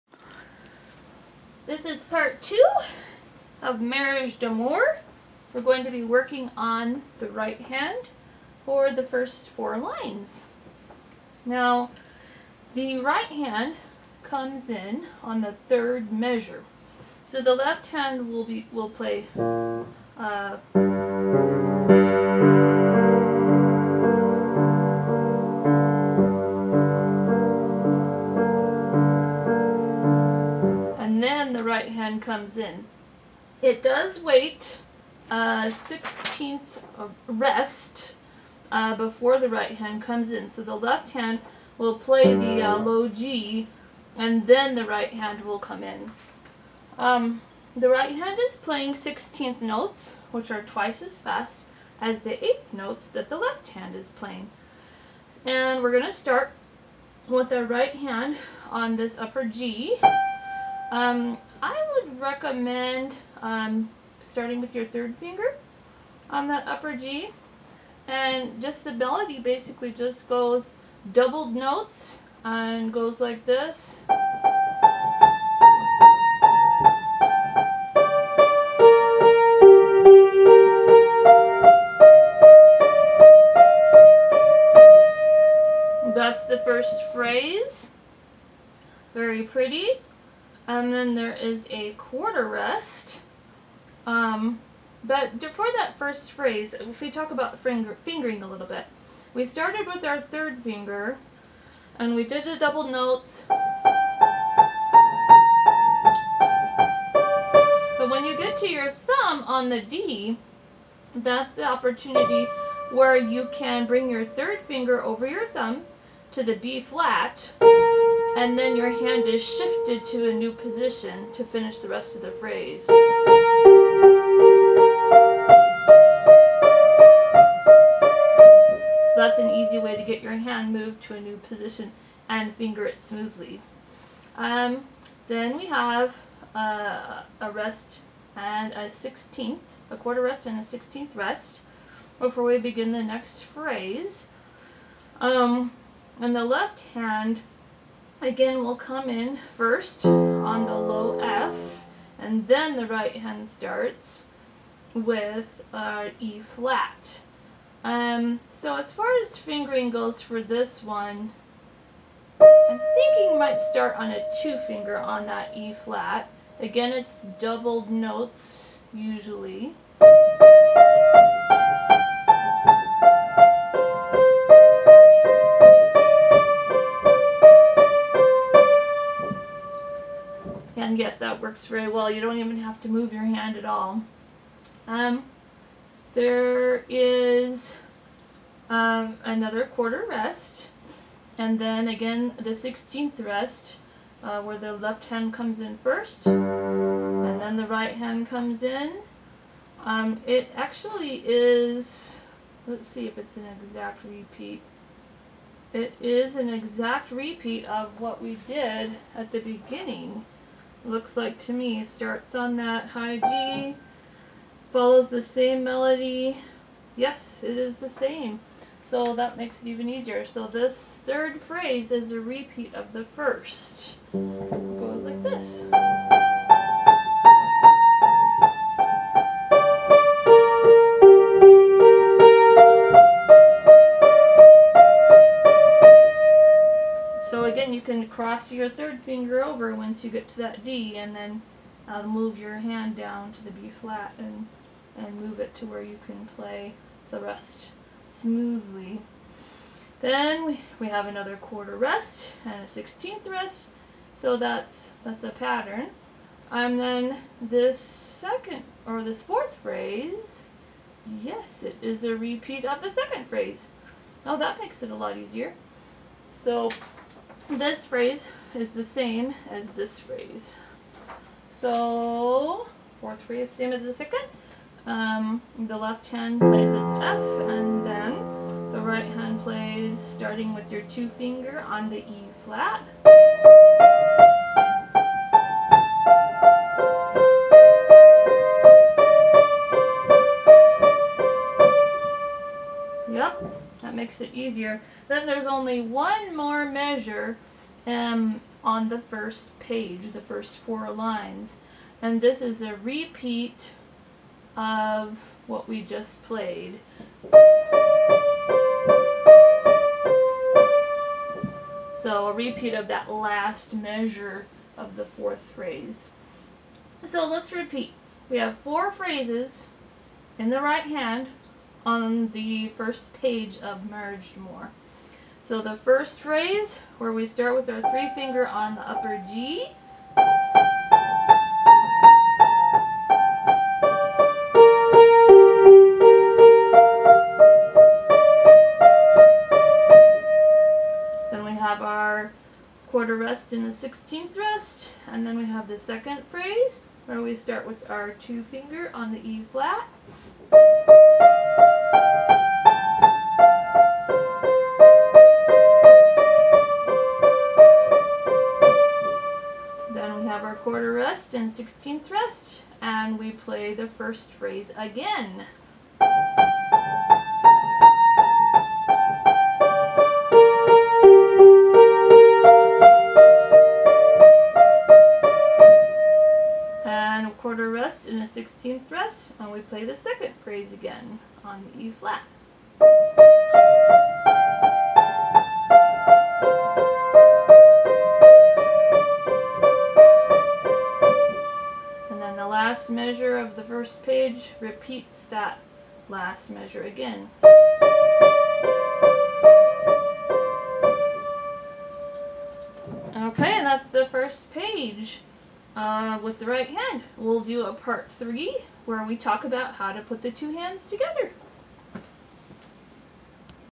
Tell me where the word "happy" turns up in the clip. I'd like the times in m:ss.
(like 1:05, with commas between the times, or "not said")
not said.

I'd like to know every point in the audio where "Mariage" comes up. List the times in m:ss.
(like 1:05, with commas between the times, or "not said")
0:03, 5:23.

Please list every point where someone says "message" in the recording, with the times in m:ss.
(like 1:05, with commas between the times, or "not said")
not said.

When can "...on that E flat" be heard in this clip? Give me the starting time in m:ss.
2:44.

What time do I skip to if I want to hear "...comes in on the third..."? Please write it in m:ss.
0:14.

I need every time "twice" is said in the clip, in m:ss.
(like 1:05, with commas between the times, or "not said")
0:50.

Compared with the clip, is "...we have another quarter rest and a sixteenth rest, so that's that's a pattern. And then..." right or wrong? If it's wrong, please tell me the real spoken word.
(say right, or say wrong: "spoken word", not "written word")
right.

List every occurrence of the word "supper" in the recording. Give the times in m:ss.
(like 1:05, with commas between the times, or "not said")
not said.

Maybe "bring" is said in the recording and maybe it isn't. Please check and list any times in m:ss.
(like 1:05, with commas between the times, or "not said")
1:53.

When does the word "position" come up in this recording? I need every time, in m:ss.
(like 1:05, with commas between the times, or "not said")
2:00, 2:11.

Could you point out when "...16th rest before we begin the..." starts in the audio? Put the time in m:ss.
2:20.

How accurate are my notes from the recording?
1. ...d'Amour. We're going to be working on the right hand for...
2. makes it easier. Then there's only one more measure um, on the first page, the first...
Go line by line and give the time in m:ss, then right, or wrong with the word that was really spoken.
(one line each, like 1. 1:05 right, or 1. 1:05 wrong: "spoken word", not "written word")
1. 0:04 right
2. 4:54 right.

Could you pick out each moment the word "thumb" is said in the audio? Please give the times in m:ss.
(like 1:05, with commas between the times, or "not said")
1:48, 1:55.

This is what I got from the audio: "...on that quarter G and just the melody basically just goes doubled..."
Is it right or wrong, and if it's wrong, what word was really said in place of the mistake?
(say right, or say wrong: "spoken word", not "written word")
wrong: "upper", not "quarter".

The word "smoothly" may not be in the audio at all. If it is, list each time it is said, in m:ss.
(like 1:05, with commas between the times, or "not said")
2:13, 4:08.